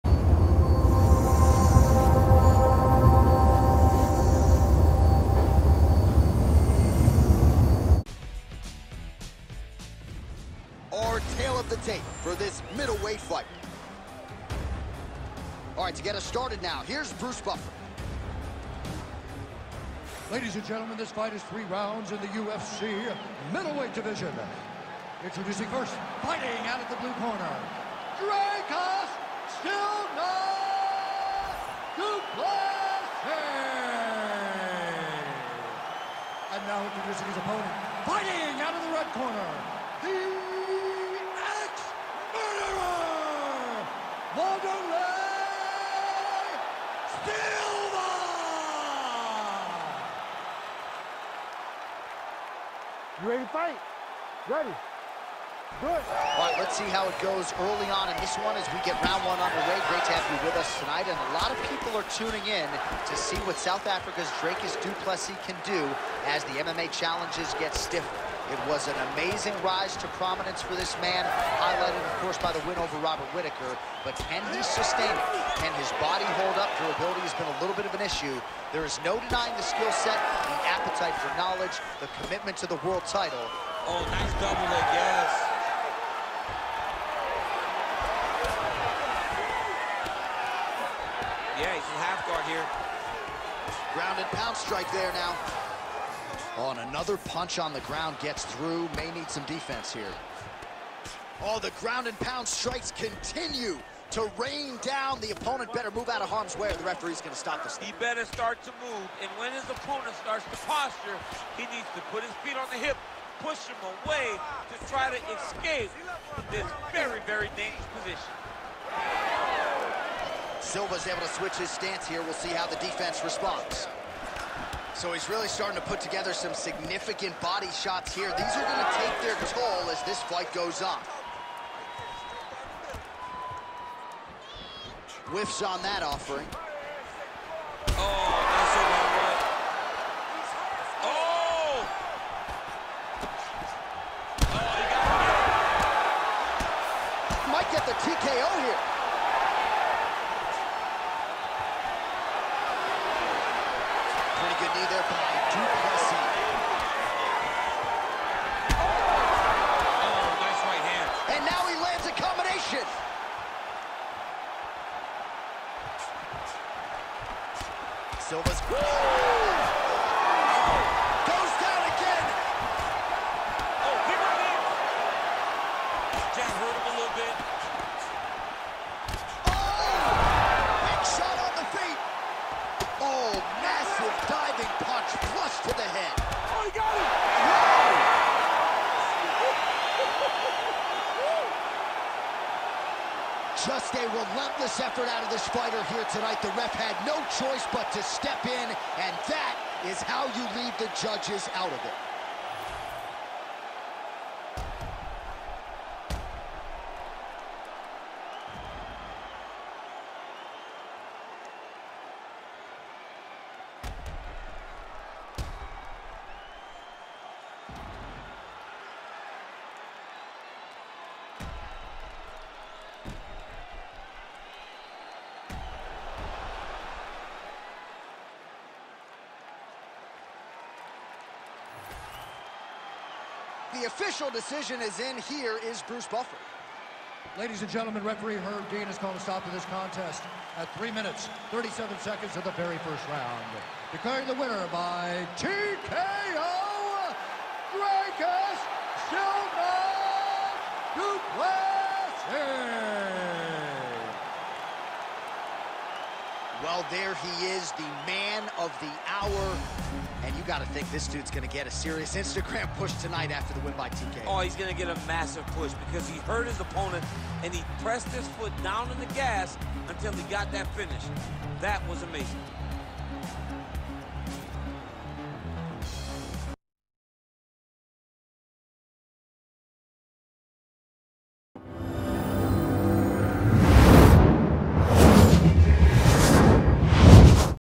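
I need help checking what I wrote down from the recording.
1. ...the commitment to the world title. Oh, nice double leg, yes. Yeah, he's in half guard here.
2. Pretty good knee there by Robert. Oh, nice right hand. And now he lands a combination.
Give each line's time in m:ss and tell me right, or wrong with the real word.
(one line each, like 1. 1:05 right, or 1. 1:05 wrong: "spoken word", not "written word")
1. 1:21 right
2. 2:34 wrong: "Duplessis", not "Robert".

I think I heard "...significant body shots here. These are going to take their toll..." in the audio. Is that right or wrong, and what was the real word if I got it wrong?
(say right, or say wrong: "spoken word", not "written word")
right.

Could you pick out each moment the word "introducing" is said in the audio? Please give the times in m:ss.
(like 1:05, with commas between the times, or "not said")
0:25, 0:36.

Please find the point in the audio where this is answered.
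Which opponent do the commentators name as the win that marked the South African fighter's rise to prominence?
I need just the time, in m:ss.
1:12.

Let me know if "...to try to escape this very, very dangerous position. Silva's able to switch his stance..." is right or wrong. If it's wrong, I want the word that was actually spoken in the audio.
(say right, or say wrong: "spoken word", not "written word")
right.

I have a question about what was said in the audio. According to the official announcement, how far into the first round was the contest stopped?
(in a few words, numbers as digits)
3 minutes, 37 seconds.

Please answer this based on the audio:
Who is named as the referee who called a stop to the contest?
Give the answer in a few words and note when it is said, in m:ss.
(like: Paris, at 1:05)
Herb Dean, at 3:58.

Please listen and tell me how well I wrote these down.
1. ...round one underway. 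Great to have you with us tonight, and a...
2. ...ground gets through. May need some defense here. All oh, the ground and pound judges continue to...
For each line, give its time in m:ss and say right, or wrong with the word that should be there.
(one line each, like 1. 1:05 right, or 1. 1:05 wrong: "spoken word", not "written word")
1. 0:59 right
2. 1:37 wrong: "strikes", not "judges".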